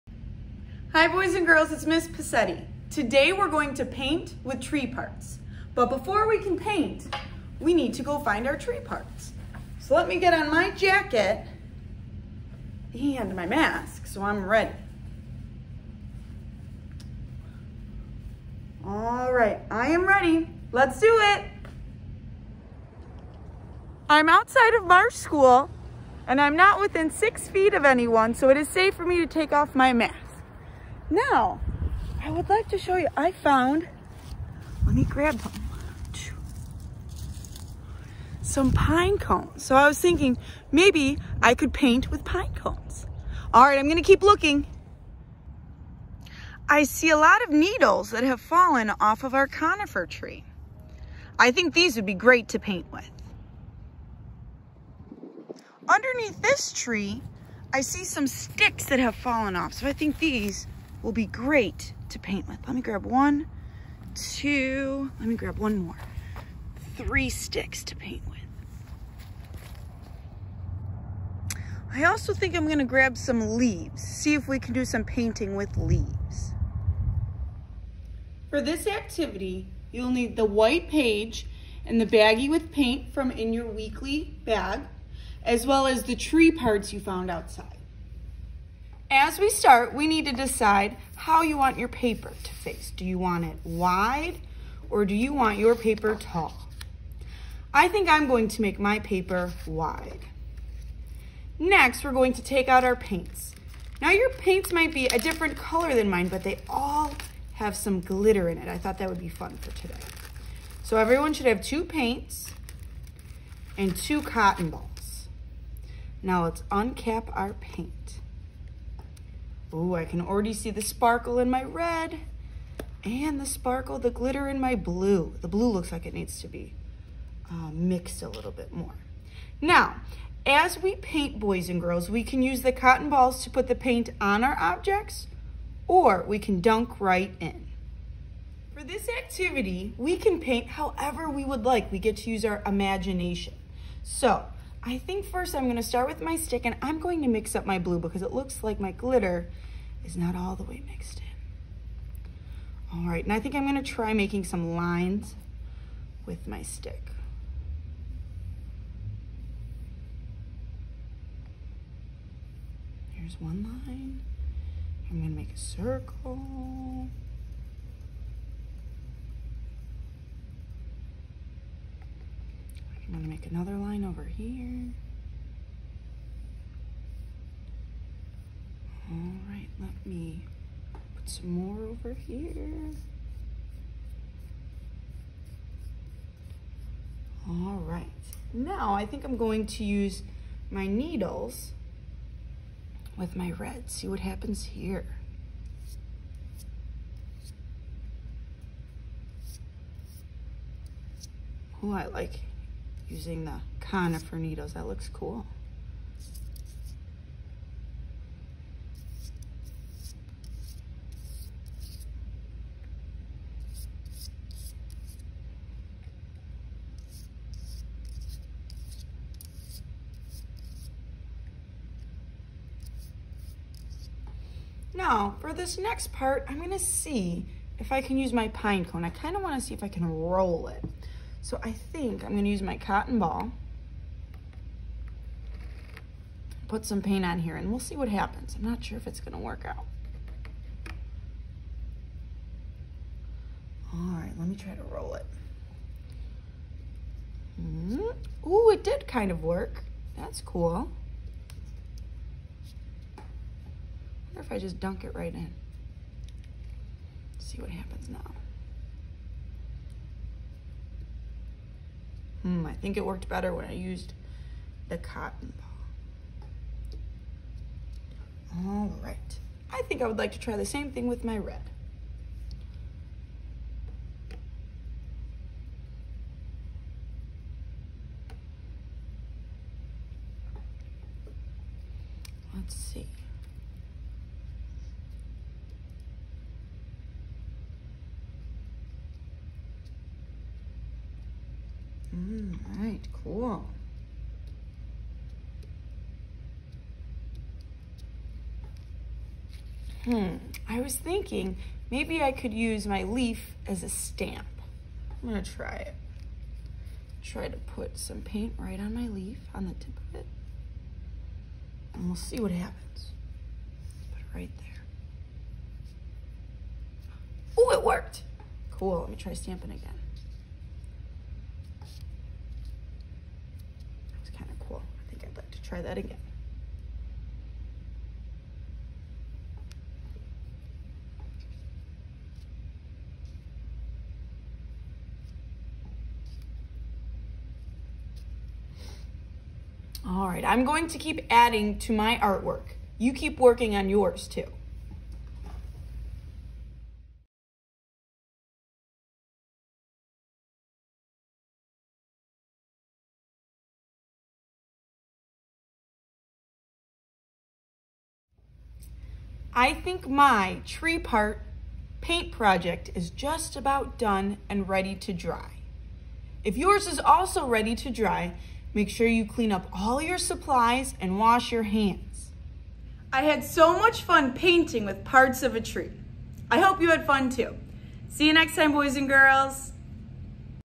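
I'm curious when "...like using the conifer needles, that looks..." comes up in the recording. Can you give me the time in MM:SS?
03:22.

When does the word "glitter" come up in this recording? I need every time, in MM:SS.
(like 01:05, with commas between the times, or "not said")
01:47, 02:04, 02:28.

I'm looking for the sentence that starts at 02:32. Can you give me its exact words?
All right, and I think I'm gonna try making some lines with my stick.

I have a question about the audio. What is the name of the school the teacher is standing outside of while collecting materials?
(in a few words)
Marsh School.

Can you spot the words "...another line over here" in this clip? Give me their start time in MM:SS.
02:53.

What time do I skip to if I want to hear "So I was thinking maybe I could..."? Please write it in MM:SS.
00:39.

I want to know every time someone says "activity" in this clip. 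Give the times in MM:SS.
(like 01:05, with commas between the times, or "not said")
01:18, 02:19.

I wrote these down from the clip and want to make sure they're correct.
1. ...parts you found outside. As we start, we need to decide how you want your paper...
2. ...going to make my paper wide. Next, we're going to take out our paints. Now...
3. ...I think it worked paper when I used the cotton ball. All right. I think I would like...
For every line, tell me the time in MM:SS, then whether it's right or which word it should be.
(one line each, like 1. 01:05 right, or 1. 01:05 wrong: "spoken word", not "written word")
1. 01:26 right
2. 01:38 right
3. 04:22 wrong: "better", not "paper".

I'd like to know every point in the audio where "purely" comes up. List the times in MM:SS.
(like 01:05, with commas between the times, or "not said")
not said.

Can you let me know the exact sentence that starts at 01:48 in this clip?
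I thought that would be fun for today.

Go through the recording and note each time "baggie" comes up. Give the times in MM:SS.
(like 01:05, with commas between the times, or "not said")
01:22.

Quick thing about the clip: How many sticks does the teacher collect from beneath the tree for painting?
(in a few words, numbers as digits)
3.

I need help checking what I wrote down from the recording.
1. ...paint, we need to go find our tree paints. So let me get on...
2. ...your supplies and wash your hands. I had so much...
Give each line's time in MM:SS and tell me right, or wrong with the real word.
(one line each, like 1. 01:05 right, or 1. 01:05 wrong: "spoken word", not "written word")
1. 00:06 wrong: "parts", not "paints"
2. 06:10 right.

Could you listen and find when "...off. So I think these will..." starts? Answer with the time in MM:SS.
00:59.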